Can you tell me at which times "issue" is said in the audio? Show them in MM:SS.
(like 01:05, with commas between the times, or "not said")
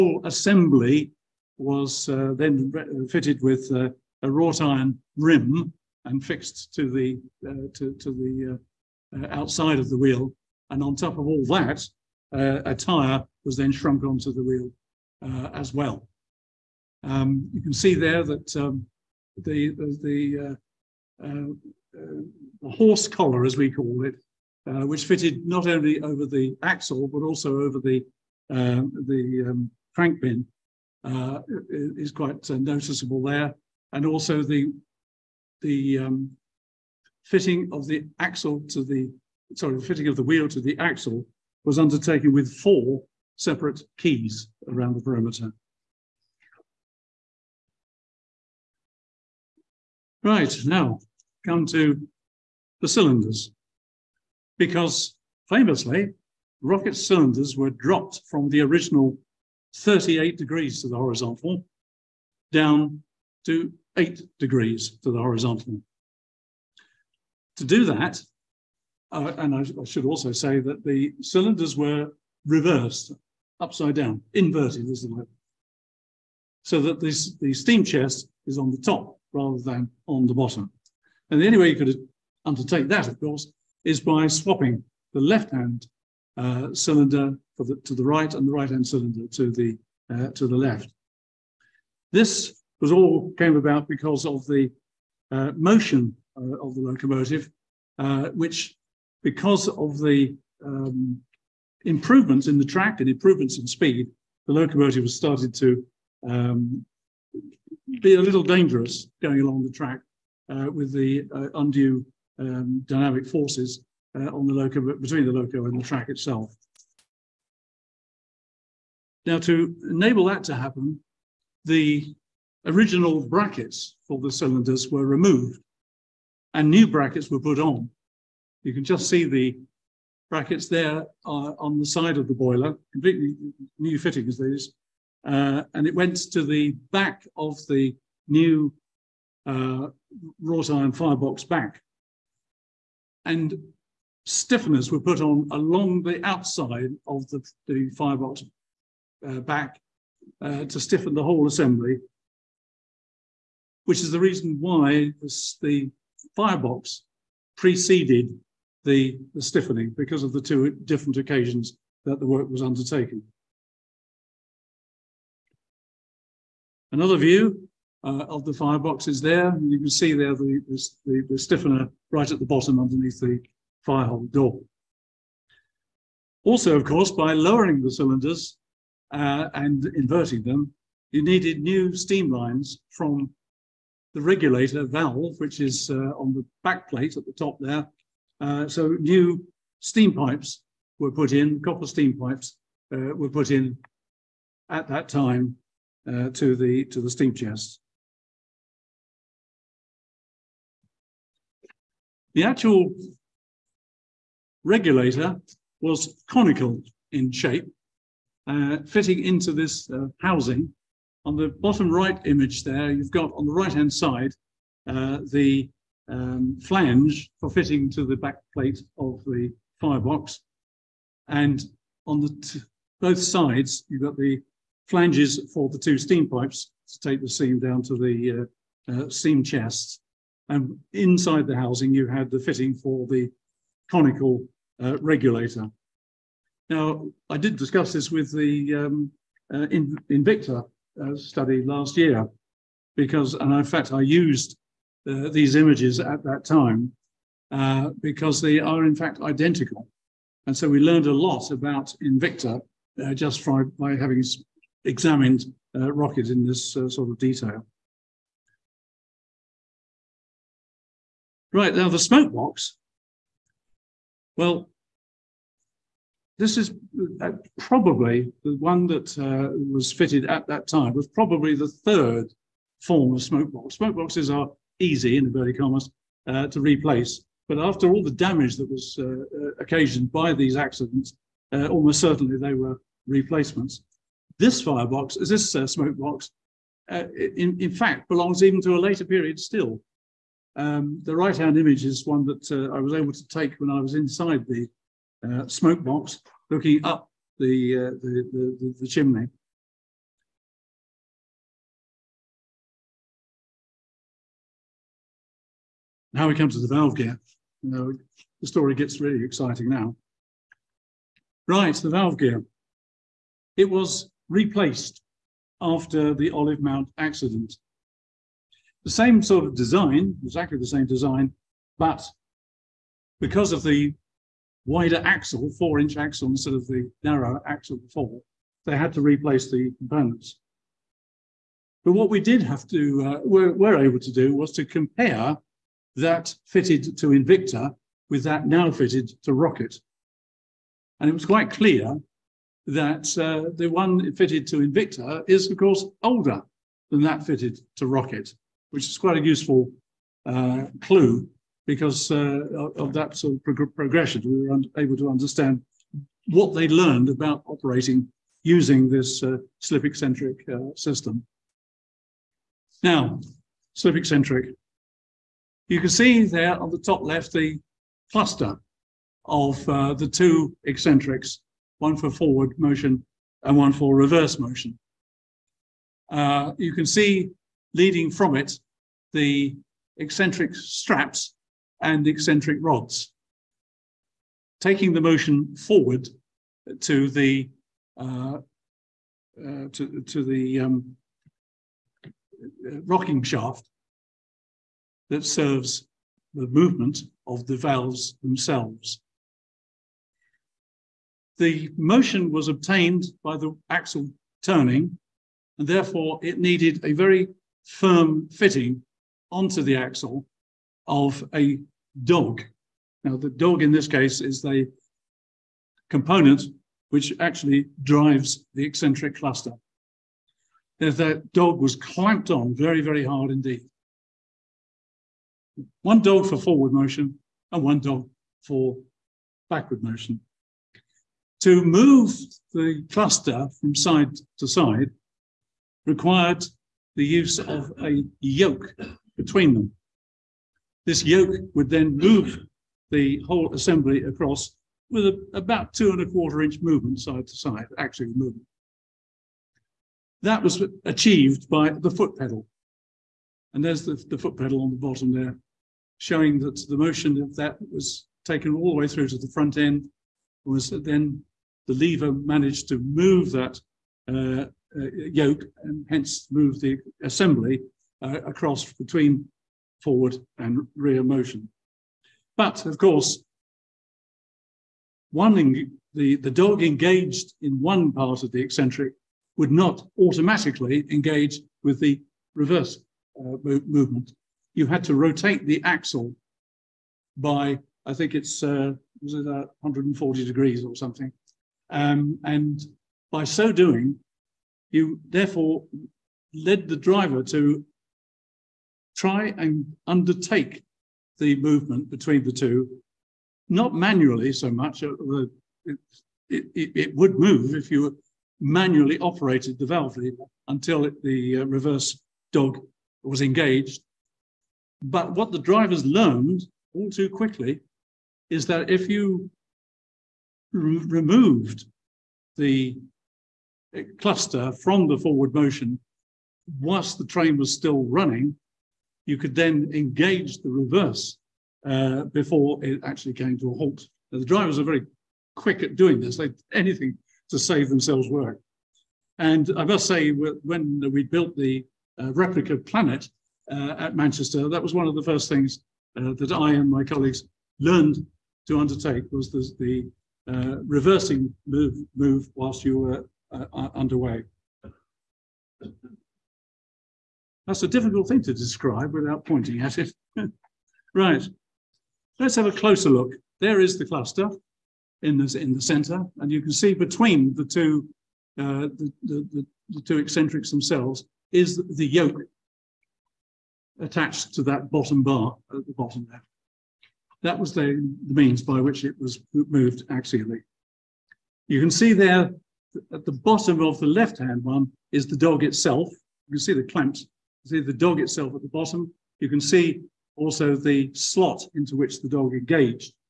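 not said.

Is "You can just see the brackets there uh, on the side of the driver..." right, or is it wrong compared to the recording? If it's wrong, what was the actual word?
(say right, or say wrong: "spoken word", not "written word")
wrong: "boiler", not "driver".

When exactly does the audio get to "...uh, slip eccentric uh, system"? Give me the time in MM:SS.
05:59.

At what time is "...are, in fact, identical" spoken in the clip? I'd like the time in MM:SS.
04:08.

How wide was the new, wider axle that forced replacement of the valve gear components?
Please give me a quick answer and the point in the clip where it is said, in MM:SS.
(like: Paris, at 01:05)
4 inch, at 05:25.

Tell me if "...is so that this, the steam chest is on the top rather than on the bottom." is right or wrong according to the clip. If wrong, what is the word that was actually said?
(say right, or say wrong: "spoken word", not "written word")
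right.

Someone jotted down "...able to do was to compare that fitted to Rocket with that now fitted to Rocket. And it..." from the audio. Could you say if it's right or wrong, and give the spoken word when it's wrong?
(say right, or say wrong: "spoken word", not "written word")
wrong: "Invicta", not "Rocket".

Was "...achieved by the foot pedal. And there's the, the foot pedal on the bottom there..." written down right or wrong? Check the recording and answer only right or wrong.
right.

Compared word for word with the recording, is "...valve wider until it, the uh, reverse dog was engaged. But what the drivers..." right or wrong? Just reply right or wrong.
wrong.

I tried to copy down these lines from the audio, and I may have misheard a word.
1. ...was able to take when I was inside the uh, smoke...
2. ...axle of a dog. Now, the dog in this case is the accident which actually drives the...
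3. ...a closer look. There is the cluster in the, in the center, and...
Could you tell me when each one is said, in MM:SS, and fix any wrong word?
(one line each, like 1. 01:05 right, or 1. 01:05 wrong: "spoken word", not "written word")
1. 04:52 right
2. 06:49 wrong: "component", not "accident"
3. 09:22 right.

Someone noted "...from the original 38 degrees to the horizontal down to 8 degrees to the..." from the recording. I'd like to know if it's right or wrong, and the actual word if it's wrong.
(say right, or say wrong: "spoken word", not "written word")
right.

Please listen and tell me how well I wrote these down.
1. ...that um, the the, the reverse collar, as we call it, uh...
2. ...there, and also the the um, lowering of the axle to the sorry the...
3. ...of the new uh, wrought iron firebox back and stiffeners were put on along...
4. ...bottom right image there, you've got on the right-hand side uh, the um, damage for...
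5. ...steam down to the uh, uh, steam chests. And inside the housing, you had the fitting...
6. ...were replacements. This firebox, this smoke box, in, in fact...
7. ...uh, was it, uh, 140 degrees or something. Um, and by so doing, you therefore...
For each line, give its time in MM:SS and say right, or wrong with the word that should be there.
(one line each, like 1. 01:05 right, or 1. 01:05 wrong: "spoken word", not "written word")
1. 00:18 wrong: "horse", not "reverse"
2. 00:33 wrong: "fitting", not "lowering"
3. 02:17 right
4. 03:31 wrong: "flange", not "damage"
5. 03:47 right
6. 04:42 right
7. 08:08 right.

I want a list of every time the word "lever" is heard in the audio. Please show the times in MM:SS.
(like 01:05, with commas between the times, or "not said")
07:41, 08:29.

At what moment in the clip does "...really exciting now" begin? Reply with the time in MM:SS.
05:08.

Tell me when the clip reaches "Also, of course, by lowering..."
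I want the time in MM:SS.
02:56.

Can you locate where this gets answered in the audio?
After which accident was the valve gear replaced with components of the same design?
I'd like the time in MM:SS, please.
05:16.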